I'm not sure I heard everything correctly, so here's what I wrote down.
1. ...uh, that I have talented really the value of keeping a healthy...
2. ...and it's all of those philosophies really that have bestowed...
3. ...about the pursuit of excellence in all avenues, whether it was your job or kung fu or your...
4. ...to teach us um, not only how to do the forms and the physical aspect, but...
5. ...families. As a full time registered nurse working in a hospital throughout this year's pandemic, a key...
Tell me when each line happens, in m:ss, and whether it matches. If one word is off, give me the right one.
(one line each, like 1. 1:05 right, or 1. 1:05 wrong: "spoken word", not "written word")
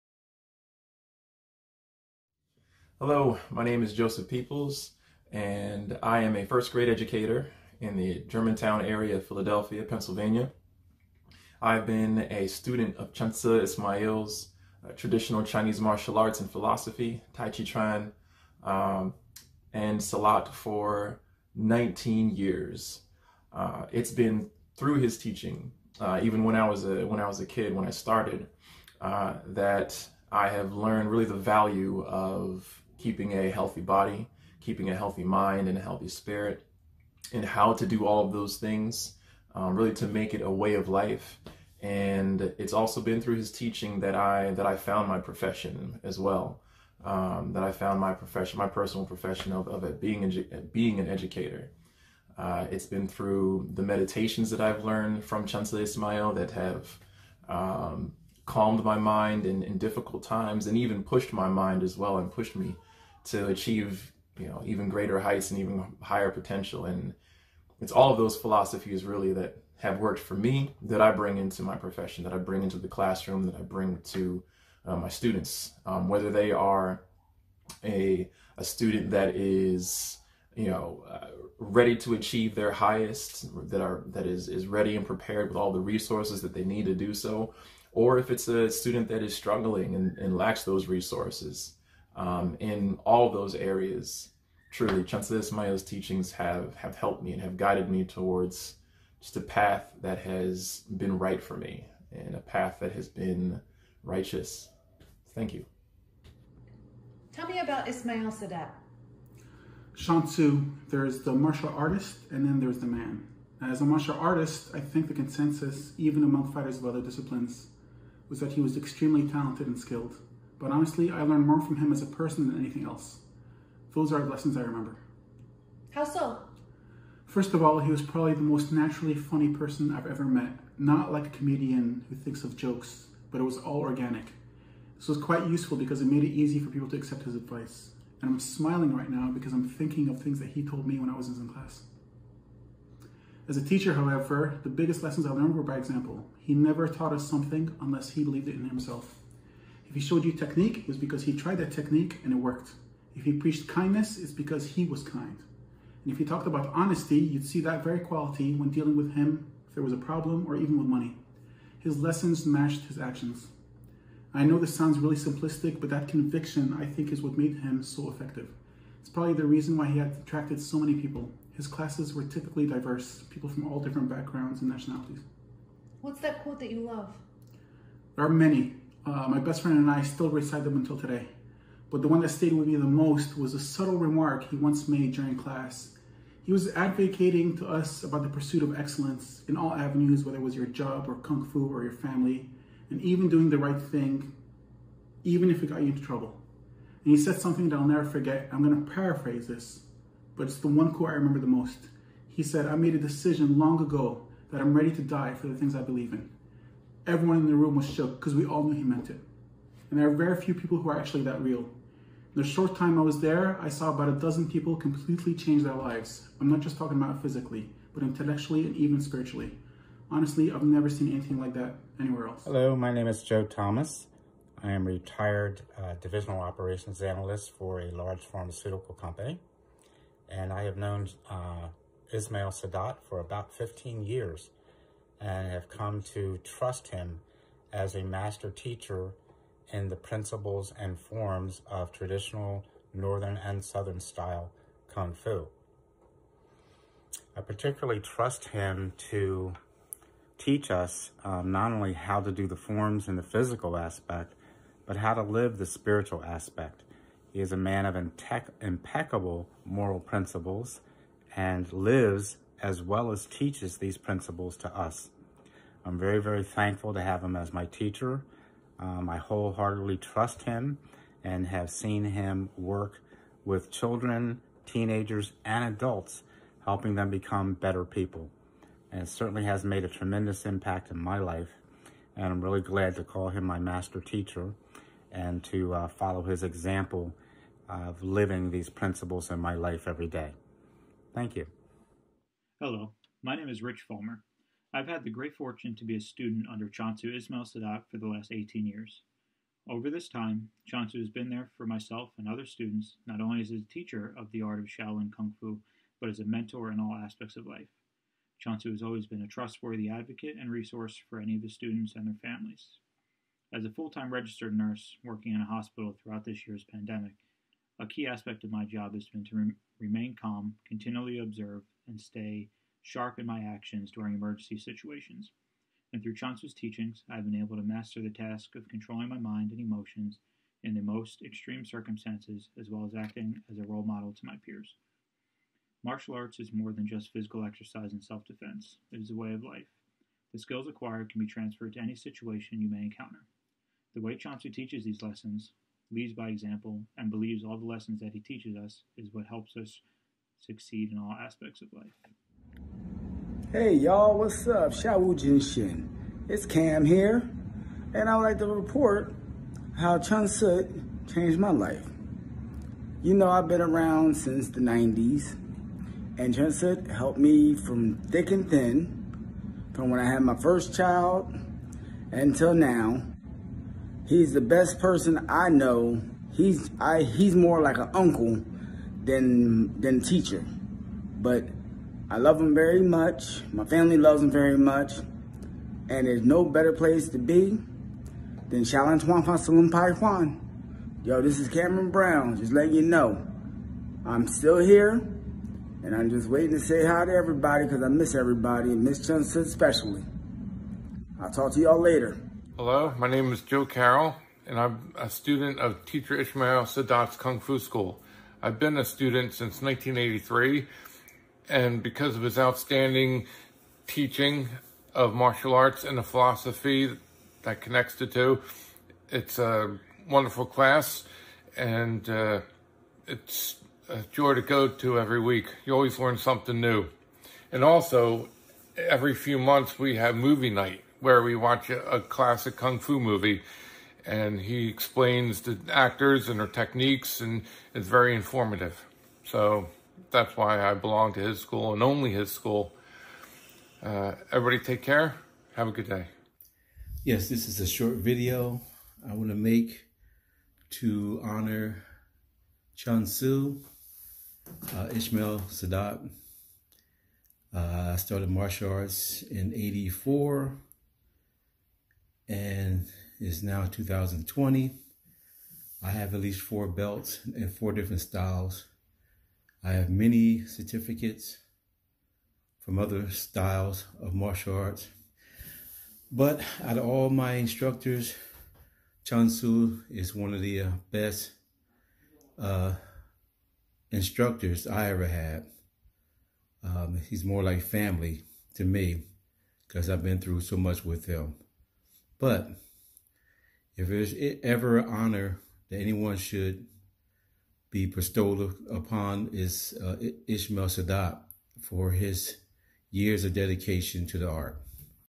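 1. 0:29 wrong: "learned", not "talented"
2. 1:06 wrong: "worked", not "bestowed"
3. 3:08 right
4. 4:09 right
5. 5:12 right.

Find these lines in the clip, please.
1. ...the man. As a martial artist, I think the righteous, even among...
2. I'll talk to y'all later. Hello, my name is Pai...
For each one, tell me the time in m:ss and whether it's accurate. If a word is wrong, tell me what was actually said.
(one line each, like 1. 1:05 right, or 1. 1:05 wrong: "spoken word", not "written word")
1. 1:52 wrong: "consensus", not "righteous"
2. 6:41 wrong: "Joe", not "Pai".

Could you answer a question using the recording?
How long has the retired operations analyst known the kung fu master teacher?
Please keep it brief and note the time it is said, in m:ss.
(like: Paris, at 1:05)
15 years, at 3:53.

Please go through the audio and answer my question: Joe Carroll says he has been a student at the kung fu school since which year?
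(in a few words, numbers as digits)
1983.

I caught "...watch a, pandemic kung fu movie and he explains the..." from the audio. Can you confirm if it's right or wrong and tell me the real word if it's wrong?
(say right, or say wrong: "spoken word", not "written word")
wrong: "classic", not "pandemic".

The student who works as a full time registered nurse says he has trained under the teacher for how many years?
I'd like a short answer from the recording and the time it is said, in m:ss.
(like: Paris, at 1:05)
18, at 4:58.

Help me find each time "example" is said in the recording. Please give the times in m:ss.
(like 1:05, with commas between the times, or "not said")
2:25, 4:46, 5:46.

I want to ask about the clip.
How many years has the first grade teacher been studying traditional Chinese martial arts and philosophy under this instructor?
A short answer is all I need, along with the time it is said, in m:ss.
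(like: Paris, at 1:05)
19, at 0:21.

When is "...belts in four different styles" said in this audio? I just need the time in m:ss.
7:46.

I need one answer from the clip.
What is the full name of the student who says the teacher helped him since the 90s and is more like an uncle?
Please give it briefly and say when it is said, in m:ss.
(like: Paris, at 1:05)
Cameron Brown, at 6:31.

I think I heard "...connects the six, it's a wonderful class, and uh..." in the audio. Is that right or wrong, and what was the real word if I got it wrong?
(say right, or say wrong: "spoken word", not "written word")
wrong: "two", not "six".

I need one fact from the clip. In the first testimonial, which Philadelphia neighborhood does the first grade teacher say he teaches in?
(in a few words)
Germantown.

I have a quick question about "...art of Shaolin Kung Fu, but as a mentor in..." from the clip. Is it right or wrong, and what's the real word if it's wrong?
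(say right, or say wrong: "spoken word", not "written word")
right.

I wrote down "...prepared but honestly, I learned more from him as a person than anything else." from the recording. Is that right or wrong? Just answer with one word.
wrong.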